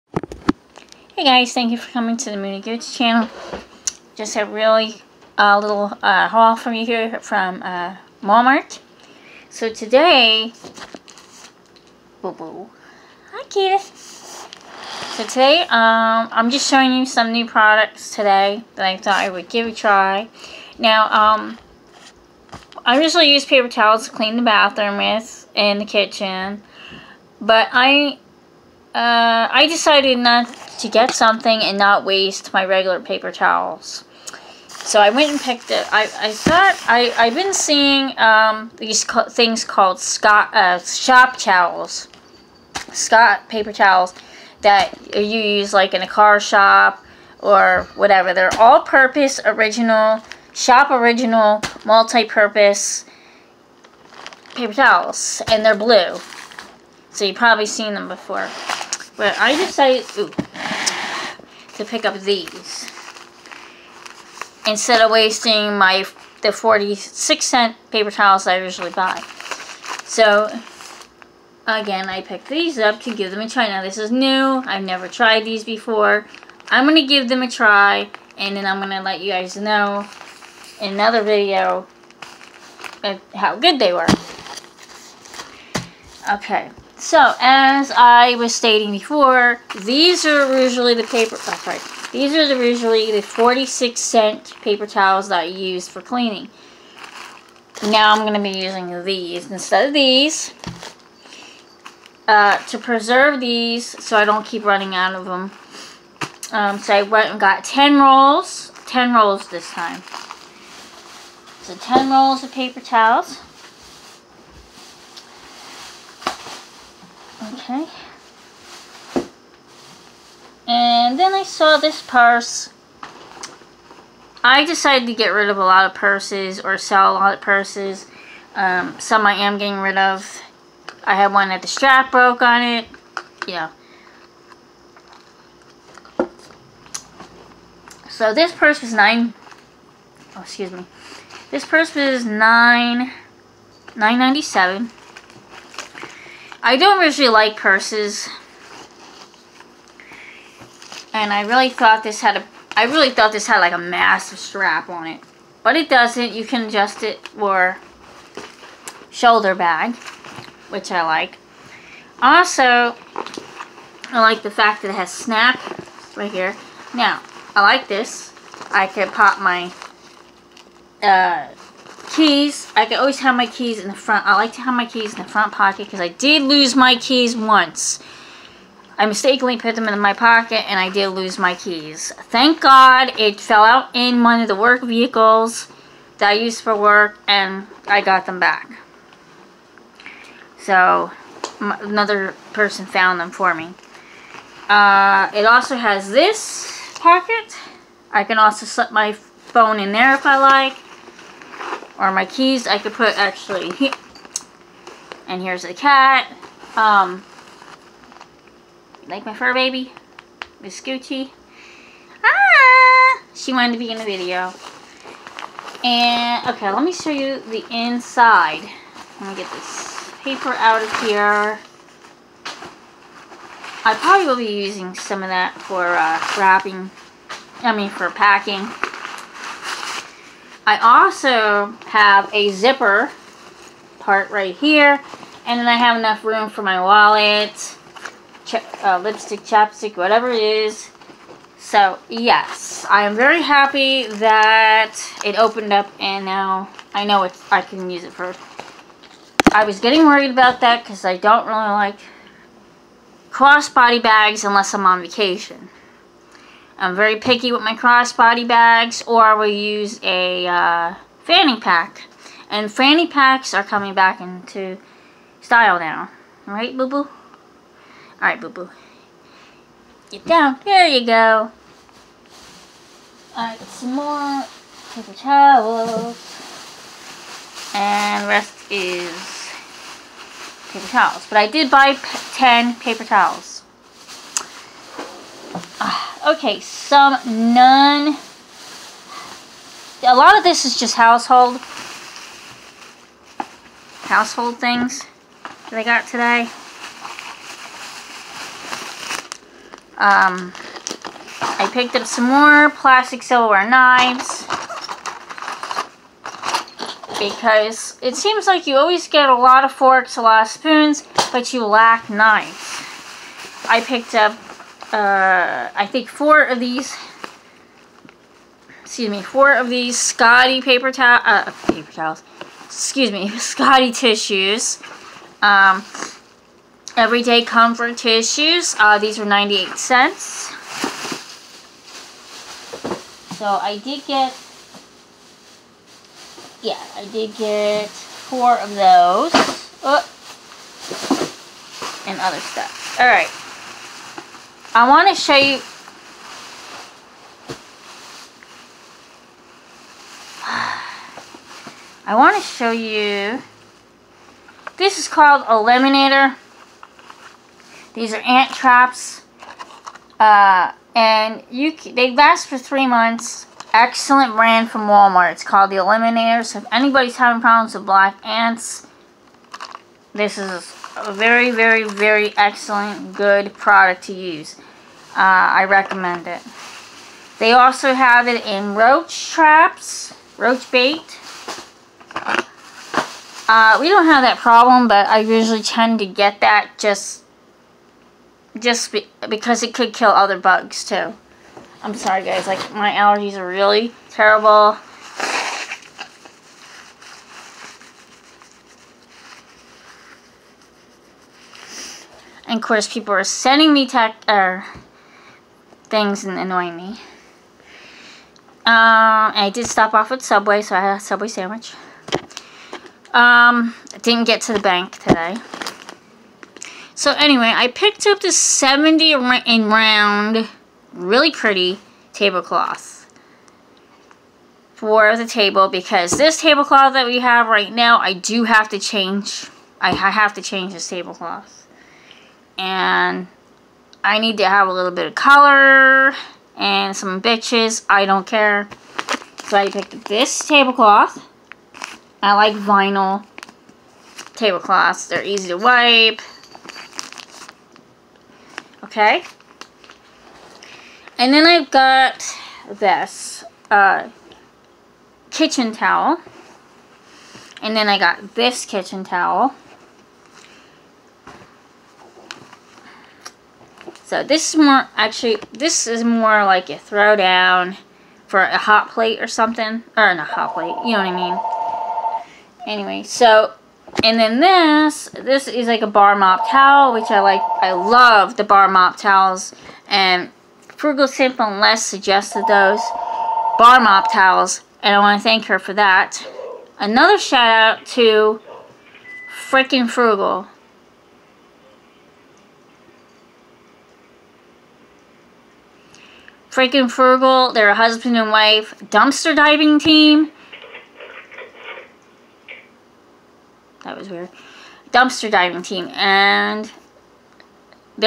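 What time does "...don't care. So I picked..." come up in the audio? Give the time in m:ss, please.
7:18.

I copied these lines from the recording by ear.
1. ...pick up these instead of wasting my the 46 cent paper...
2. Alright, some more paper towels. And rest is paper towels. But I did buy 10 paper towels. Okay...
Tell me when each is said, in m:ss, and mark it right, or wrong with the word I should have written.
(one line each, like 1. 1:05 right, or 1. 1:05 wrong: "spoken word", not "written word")
1. 1:01 right
2. 4:33 right.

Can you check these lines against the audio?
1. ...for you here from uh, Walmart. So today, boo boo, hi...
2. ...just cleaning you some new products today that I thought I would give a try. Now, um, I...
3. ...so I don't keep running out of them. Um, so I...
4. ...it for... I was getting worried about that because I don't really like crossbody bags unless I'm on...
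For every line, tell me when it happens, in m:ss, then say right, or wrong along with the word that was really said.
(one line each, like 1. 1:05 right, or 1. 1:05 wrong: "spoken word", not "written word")
1. 0:06 right
2. 0:16 wrong: "showing", not "cleaning"
3. 1:44 right
4. 4:08 right.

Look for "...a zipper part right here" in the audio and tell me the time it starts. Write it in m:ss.
3:52.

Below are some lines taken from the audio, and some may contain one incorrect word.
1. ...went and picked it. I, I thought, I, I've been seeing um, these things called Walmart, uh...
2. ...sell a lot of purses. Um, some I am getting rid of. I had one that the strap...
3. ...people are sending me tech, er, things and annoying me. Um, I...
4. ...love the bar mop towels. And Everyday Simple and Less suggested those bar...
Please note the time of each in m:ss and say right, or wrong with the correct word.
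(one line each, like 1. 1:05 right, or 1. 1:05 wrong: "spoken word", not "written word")
1. 0:35 wrong: "Scott", not "Walmart"
2. 2:06 right
3. 6:42 right
4. 7:57 wrong: "Frugal", not "Everyday".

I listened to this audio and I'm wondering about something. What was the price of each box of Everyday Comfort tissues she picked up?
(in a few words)
98 cents.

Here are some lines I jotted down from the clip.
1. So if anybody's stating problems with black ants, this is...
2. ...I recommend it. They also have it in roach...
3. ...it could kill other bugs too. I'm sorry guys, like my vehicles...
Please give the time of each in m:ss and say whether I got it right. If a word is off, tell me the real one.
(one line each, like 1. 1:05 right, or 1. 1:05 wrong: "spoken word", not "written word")
1. 6:06 wrong: "having", not "stating"
2. 6:15 right
3. 6:29 wrong: "allergies", not "vehicles".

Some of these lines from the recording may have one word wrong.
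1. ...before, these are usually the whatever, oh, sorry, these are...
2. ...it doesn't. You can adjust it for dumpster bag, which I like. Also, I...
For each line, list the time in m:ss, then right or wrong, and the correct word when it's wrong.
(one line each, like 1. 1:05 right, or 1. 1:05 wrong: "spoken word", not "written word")
1. 1:28 wrong: "paper", not "whatever"
2. 2:35 wrong: "shoulder", not "dumpster".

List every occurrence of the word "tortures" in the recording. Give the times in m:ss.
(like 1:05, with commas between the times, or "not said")
not said.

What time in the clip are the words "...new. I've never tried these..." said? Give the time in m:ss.
1:14.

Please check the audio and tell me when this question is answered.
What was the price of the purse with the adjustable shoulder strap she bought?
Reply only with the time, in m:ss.
2:23.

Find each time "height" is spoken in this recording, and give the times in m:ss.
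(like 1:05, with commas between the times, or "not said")
not said.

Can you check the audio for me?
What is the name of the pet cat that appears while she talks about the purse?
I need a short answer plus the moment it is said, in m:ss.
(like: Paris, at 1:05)
Miss Gucci, at 3:30.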